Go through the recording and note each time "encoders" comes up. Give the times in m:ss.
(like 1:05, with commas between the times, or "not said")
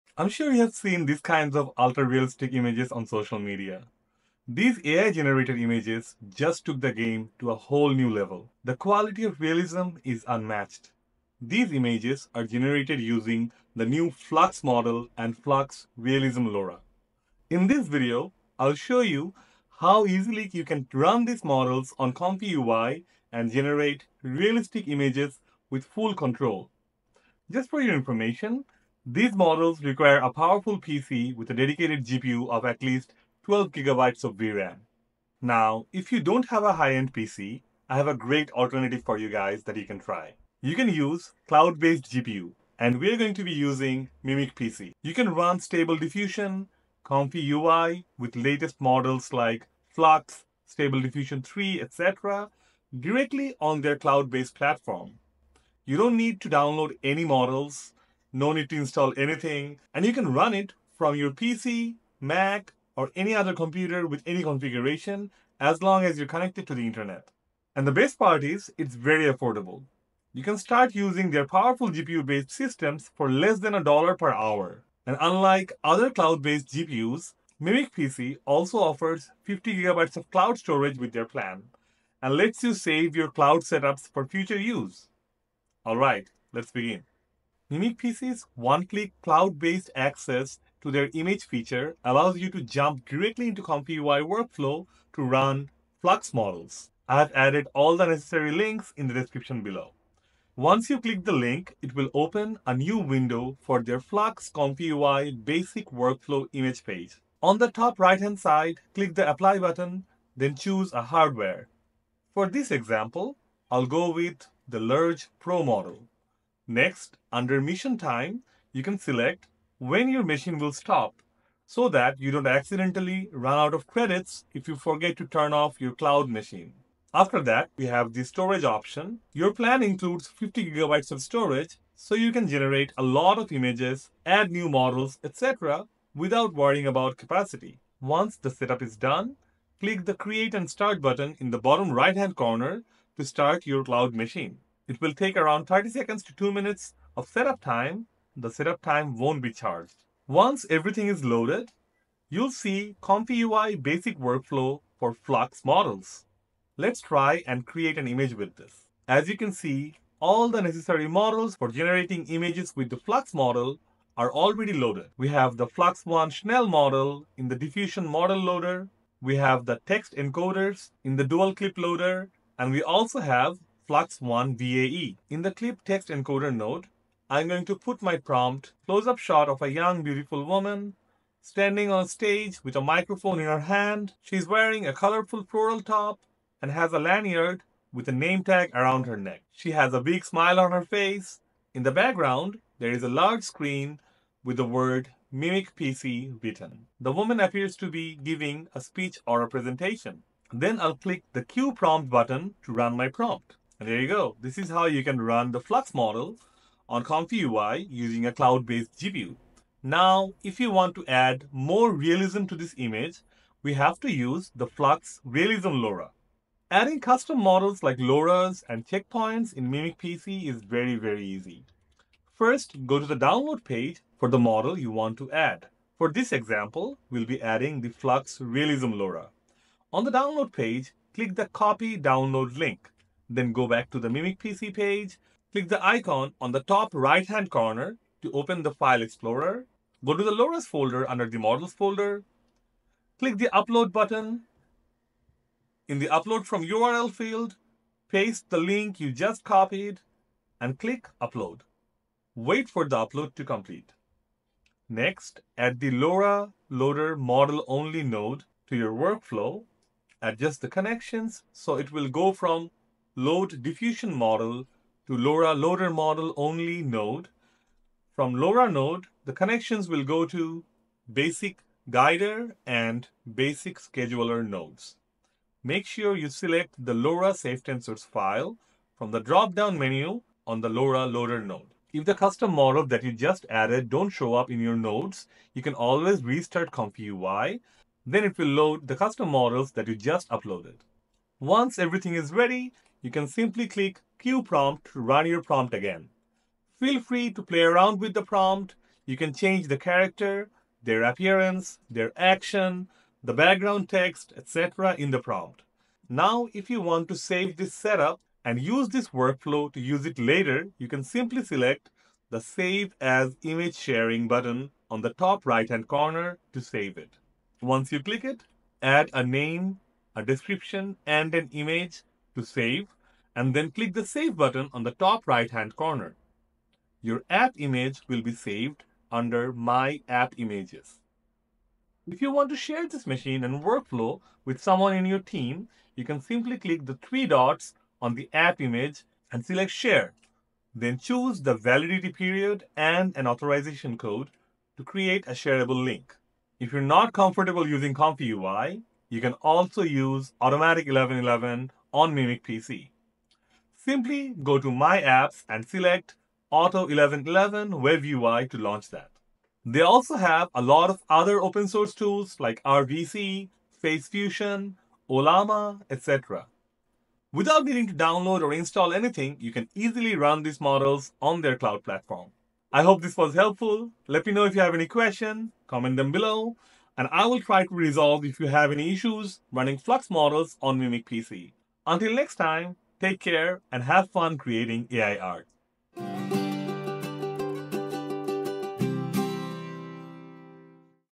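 2:50, 2:56.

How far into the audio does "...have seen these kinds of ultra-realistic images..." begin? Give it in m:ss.
0:00.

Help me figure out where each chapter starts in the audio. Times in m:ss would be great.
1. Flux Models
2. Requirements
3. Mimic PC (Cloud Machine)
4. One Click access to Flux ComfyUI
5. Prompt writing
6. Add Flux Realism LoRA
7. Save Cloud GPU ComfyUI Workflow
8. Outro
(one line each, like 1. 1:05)
1. 0:13
2. 0:27
3. 0:40
4. 1:28
5. 2:58
6. 3:30
7. 5:12
8. 6:12.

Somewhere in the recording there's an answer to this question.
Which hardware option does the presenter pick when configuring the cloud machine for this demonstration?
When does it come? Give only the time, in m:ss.
1:54.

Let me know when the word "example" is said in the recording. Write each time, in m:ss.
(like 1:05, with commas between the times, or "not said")
1:52, 3:46.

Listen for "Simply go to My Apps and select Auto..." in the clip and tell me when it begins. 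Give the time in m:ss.
5:53.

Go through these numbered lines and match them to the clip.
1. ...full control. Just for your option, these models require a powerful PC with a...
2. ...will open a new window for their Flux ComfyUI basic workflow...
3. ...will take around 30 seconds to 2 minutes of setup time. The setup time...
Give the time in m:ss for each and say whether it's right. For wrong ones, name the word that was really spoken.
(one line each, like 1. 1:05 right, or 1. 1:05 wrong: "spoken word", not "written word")
1. 0:25 wrong: "information", not "option"
2. 1:41 right
3. 2:24 right.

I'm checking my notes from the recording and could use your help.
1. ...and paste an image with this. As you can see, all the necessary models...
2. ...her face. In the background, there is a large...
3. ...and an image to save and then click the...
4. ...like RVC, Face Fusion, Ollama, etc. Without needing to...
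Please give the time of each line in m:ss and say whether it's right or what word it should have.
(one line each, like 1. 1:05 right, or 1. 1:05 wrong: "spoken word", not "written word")
1. 2:37 wrong: "create", not "paste"
2. 3:10 right
3. 5:21 right
4. 6:02 right.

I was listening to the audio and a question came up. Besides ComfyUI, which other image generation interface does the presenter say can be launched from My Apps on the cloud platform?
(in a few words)
Automatic 1111.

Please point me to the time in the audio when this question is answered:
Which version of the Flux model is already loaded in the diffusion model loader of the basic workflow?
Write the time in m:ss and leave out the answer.
2:45.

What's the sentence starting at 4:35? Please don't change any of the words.
Make sure you select the LoRa safe tensors file from the drop-down menu on the LoRa loader node.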